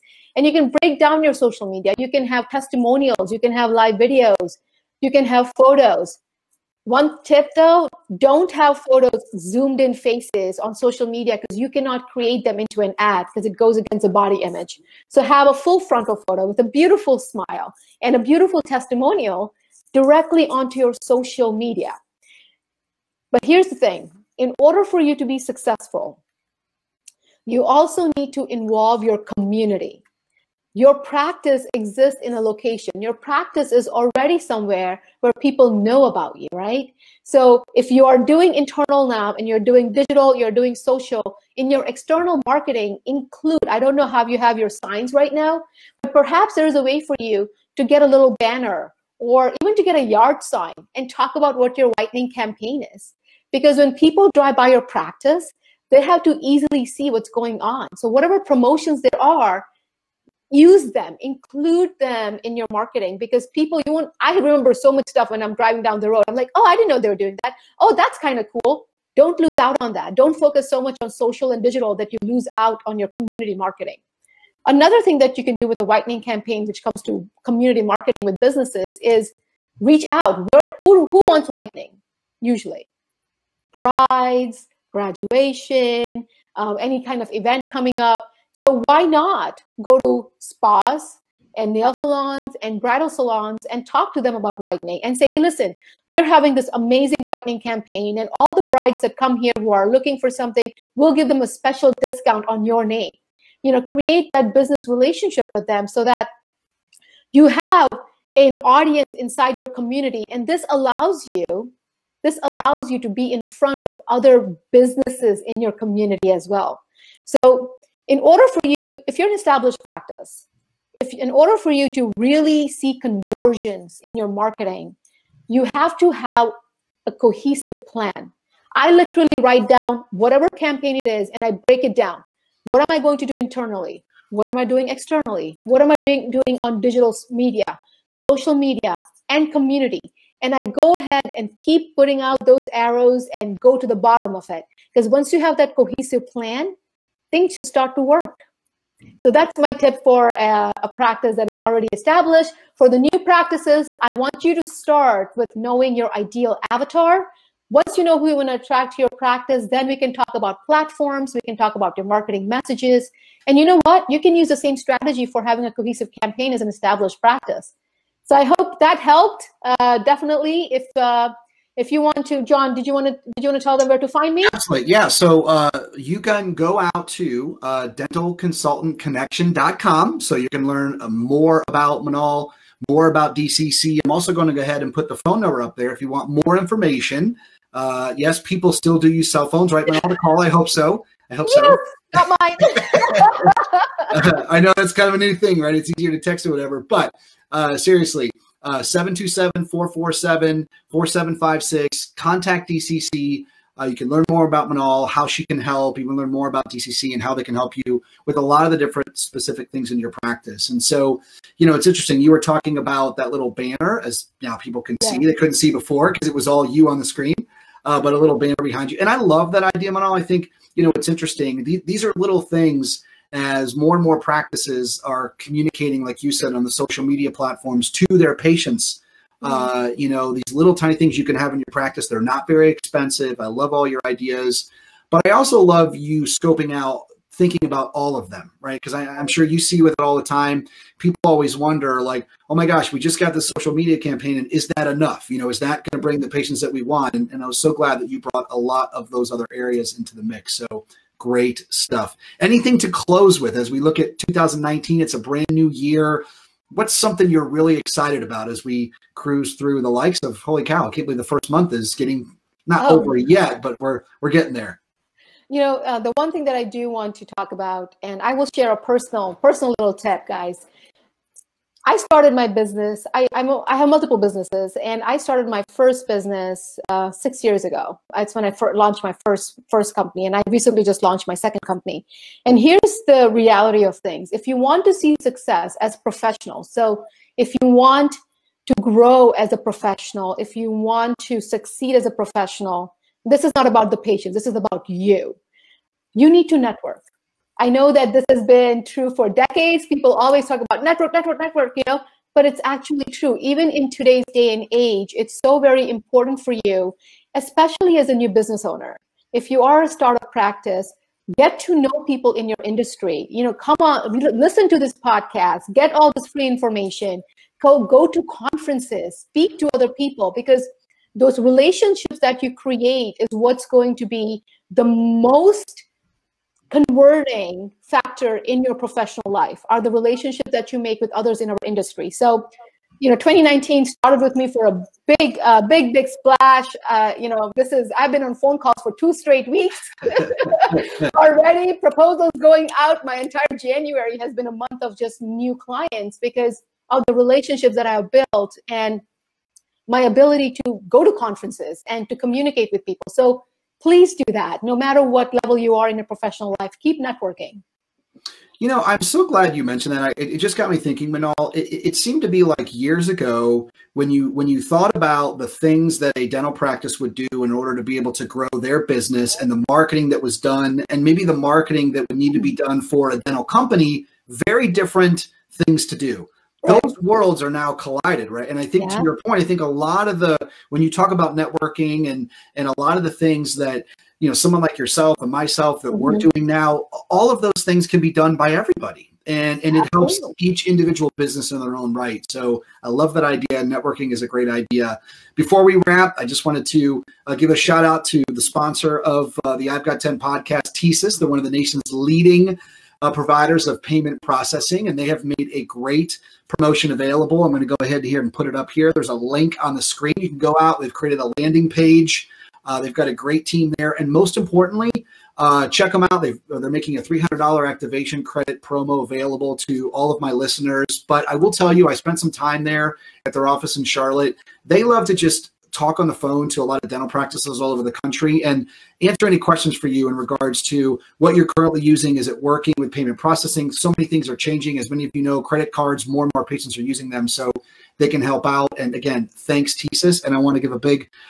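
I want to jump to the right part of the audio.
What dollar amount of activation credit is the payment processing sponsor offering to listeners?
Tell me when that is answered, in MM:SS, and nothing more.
06:57.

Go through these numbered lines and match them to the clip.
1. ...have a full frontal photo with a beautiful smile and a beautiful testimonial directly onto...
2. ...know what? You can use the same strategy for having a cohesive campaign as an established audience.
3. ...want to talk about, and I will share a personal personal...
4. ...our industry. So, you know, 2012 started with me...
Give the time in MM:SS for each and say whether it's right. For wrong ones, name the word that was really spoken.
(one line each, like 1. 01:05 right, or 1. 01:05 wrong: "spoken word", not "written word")
1. 00:15 right
2. 02:43 wrong: "practice", not "audience"
3. 04:26 right
4. 05:31 wrong: "2019", not "2012".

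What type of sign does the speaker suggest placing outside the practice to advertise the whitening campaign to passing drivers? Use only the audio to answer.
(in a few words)
Yard sign.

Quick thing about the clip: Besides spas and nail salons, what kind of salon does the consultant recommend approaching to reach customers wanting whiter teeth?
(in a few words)
Bridal salons.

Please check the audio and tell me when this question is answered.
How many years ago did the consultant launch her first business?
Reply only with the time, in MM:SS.
04:37.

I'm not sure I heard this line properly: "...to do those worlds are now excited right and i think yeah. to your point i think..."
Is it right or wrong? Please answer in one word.
wrong.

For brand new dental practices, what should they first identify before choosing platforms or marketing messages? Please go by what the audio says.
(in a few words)
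Ideal avatar.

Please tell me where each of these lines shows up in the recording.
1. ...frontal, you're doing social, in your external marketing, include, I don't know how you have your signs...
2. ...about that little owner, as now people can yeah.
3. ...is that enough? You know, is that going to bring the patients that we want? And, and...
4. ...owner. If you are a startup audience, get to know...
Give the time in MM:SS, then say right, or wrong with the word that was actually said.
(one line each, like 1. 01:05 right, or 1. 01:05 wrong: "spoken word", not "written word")
1. 00:39 wrong: "digital", not "frontal"
2. 03:32 wrong: "banner", not "owner"
3. 04:04 right
4. 05:08 wrong: "practice", not "audience".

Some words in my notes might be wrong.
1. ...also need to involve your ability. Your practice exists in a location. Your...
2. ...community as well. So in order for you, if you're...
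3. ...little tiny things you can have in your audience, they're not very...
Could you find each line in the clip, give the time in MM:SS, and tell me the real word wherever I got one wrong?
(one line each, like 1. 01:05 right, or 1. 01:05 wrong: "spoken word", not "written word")
1. 00:27 wrong: "community", not "ability"
2. 01:55 right
3. 03:50 wrong: "practice", not "audience".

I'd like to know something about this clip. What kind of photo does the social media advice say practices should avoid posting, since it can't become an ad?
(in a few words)
Zoomed in faces.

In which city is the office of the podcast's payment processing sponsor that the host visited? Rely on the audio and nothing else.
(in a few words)
Charlotte.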